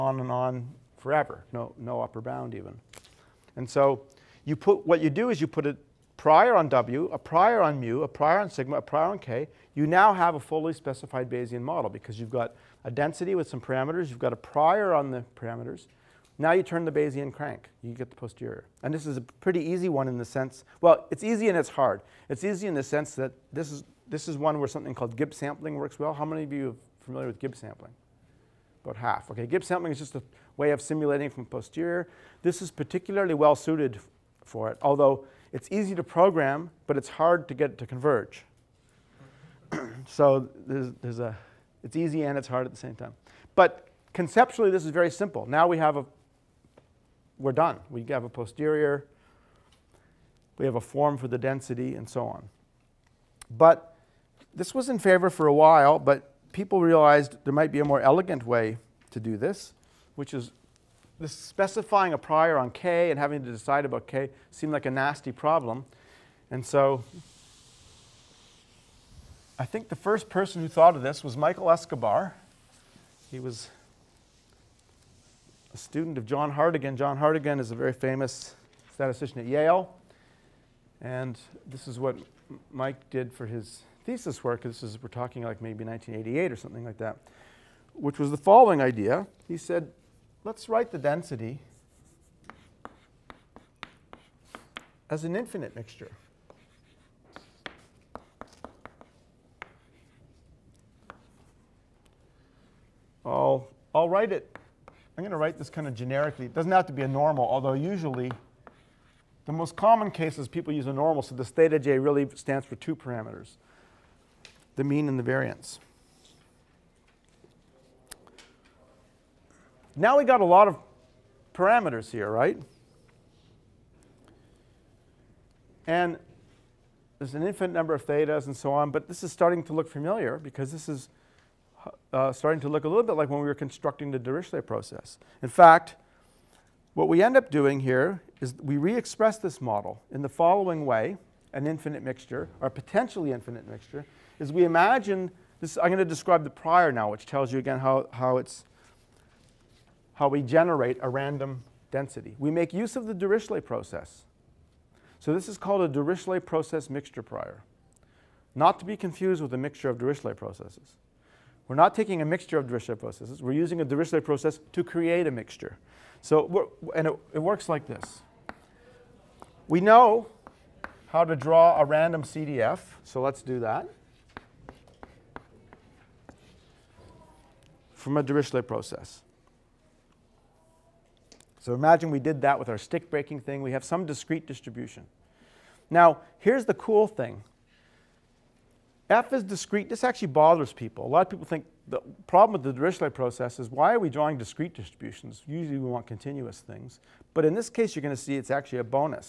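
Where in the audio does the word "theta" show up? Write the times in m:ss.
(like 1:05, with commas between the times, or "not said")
1:51, 2:08.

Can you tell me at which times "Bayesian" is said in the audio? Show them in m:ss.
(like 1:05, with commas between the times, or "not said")
0:11, 0:16.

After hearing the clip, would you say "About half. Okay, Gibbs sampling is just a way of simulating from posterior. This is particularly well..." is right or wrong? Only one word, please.
right.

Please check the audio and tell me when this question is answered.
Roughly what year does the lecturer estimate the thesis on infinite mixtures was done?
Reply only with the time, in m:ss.
1:25.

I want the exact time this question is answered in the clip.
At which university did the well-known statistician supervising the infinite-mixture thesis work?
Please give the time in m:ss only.
1:19.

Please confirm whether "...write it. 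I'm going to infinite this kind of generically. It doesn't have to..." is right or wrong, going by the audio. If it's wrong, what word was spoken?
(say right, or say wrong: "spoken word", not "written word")
wrong: "write", not "infinite".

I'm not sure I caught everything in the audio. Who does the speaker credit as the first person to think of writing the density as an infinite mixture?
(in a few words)
Michael Escobar.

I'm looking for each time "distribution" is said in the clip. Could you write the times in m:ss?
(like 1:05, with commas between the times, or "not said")
3:04, 3:14.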